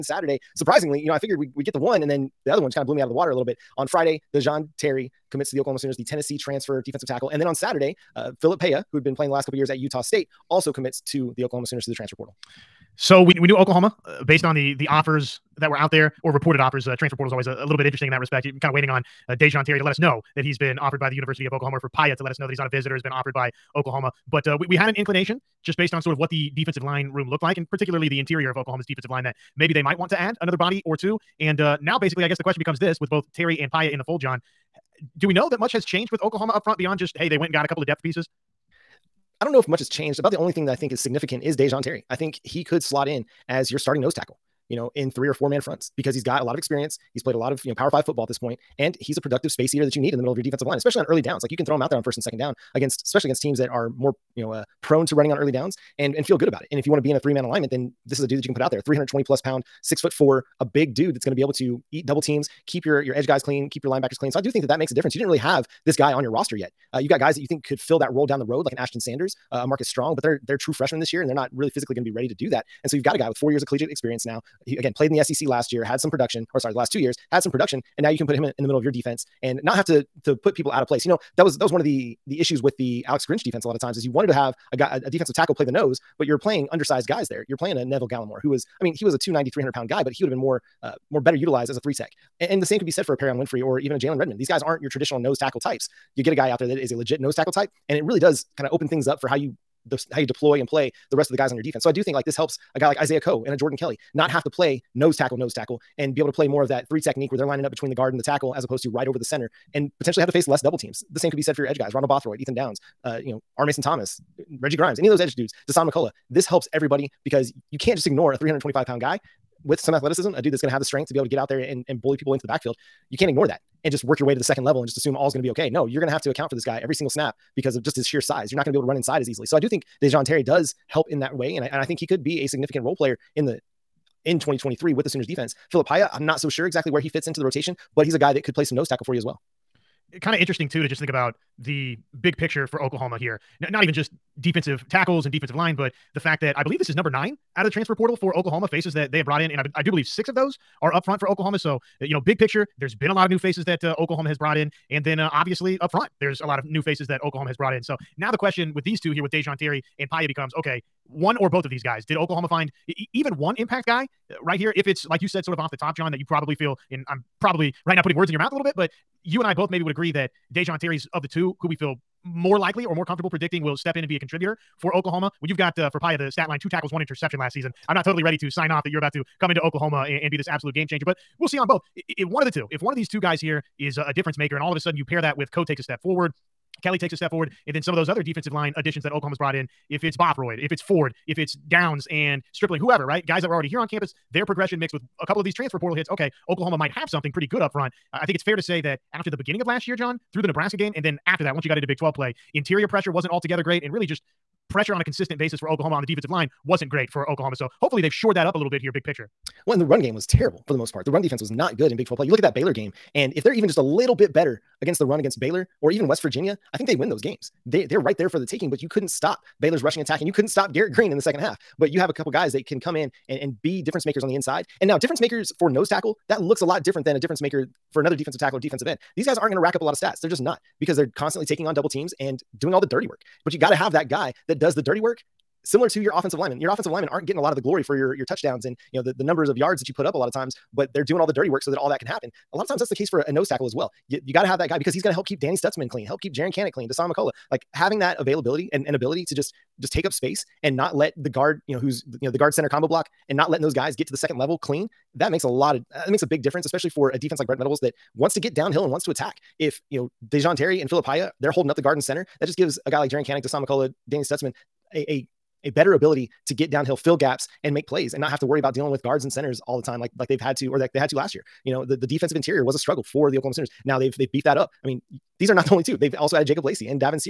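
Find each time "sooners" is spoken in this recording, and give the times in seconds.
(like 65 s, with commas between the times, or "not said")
5 s, 11 s, 135 s, 273 s.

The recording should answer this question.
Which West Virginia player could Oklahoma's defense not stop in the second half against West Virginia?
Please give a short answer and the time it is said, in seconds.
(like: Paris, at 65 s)
Garrett Greene, at 220 s.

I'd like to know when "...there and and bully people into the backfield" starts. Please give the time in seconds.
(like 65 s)
121 s.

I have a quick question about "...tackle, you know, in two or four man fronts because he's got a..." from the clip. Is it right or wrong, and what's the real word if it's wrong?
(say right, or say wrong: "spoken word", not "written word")
wrong: "three", not "two".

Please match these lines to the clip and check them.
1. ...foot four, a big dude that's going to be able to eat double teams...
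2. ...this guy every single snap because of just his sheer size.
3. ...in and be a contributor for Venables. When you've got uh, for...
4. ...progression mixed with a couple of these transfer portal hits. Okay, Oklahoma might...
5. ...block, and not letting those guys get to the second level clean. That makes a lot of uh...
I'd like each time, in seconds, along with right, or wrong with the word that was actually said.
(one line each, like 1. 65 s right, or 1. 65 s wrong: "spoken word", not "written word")
1. 59 s right
2. 126 s right
3. 173 s wrong: "Oklahoma", not "Venables"
4. 194 s right
5. 252 s right.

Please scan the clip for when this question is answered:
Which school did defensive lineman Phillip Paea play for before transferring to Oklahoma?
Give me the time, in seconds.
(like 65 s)
9 s.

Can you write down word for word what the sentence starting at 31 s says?
And uh, now, basically, I guess the question becomes this with both Terry and Paea in the fold, John.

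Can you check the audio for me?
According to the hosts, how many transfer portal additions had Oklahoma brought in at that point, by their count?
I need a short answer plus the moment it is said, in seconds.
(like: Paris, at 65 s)
9, at 146 s.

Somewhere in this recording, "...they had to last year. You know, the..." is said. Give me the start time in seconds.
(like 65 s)
270 s.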